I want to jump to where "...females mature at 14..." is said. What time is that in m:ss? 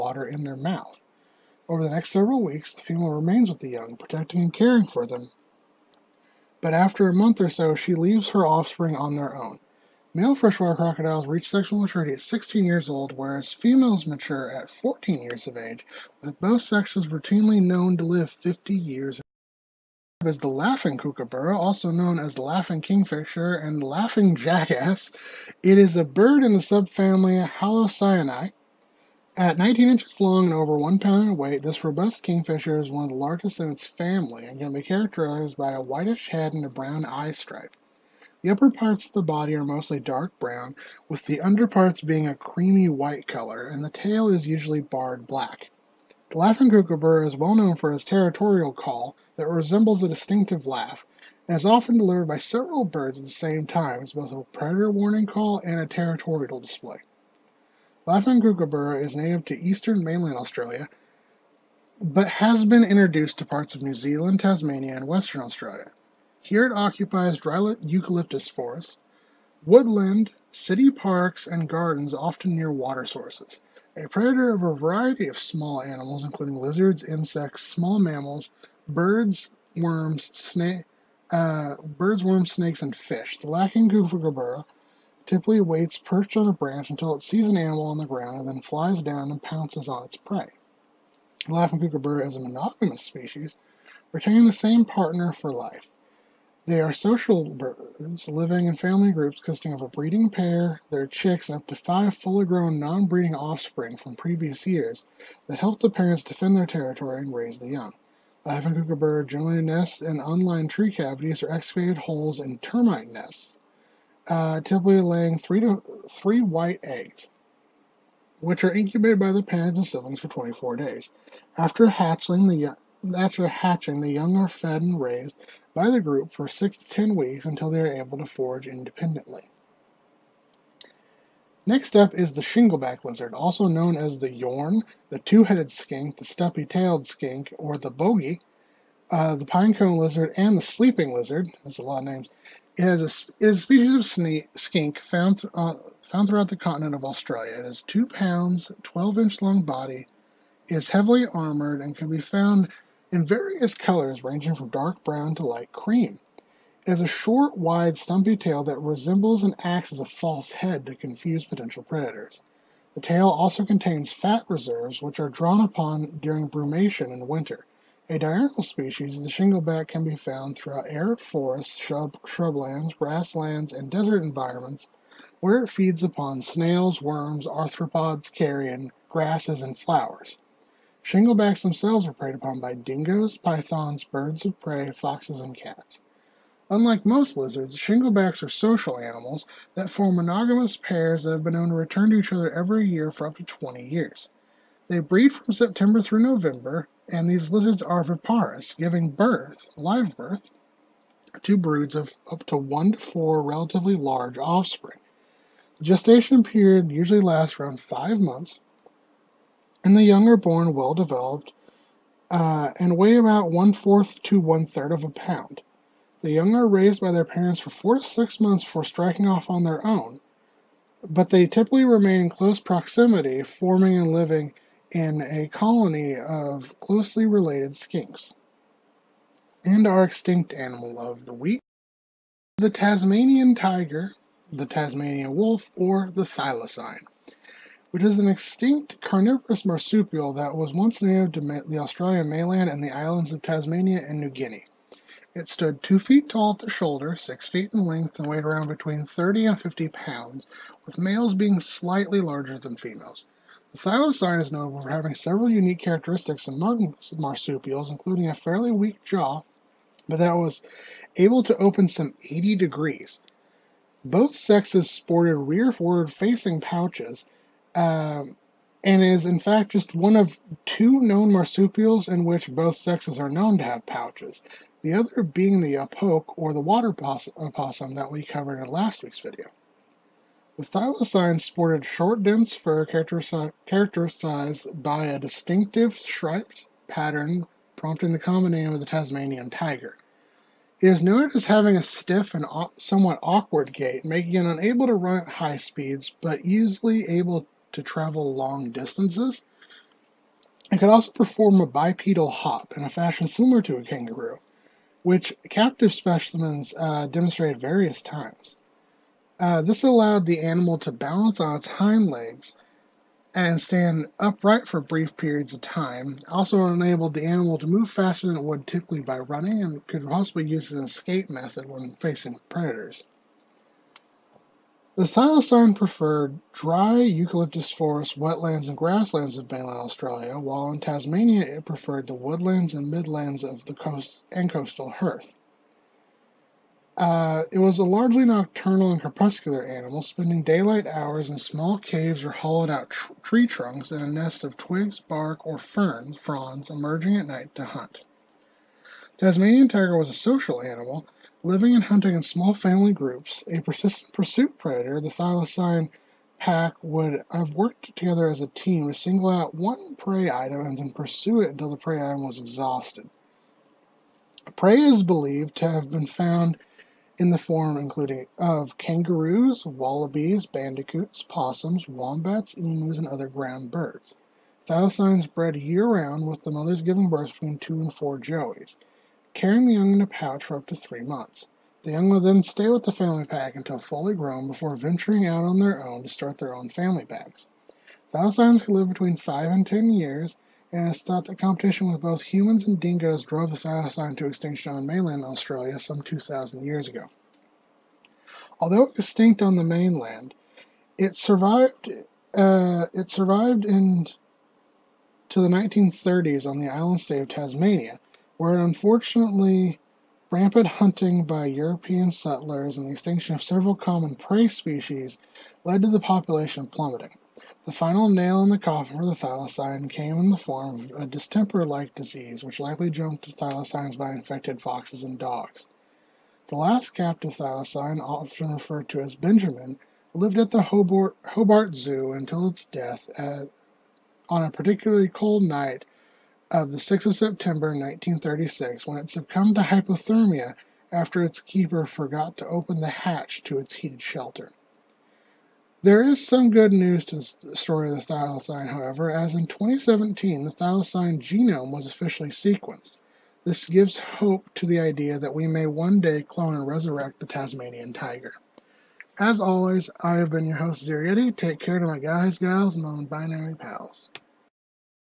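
0:13.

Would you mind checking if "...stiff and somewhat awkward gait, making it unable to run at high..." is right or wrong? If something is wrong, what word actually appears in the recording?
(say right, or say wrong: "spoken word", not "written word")
right.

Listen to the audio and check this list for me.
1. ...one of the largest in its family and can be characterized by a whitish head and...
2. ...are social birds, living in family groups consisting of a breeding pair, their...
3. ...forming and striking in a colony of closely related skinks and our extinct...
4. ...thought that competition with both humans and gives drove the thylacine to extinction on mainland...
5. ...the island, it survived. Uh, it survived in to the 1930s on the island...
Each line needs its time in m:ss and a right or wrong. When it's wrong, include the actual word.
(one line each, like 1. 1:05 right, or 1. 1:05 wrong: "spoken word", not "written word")
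1. 0:32 right
2. 1:36 right
3. 3:43 wrong: "living", not "striking"
4. 6:31 wrong: "dingoes", not "gives"
5. 6:39 wrong: "mainland", not "island".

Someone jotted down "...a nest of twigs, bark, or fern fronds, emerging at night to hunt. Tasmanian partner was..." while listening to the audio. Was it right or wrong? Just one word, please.
wrong.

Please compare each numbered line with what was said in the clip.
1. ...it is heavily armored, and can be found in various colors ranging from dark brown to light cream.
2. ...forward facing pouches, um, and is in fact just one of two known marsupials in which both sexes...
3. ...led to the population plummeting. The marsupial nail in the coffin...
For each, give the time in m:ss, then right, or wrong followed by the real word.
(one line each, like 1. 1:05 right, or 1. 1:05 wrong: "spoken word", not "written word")
1. 2:30 right
2. 4:25 right
3. 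6:55 wrong: "final", not "marsupial".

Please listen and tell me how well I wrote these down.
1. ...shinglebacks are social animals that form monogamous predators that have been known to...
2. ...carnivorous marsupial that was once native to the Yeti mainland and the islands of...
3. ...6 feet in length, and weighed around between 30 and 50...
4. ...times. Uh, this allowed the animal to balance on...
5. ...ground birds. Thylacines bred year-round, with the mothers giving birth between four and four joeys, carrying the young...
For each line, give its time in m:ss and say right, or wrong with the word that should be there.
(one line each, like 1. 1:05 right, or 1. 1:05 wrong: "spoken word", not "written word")
1. 3:07 wrong: "pairs", not "predators"
2. 3:58 wrong: "Australian", not "Yeti"
3. 4:07 right
4. 5:08 right
5. 6:13 wrong: "two", not "four".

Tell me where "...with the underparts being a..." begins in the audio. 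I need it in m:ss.
0:41.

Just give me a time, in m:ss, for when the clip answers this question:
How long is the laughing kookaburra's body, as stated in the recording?
0:29.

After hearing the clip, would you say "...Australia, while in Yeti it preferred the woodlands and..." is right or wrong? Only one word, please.
wrong.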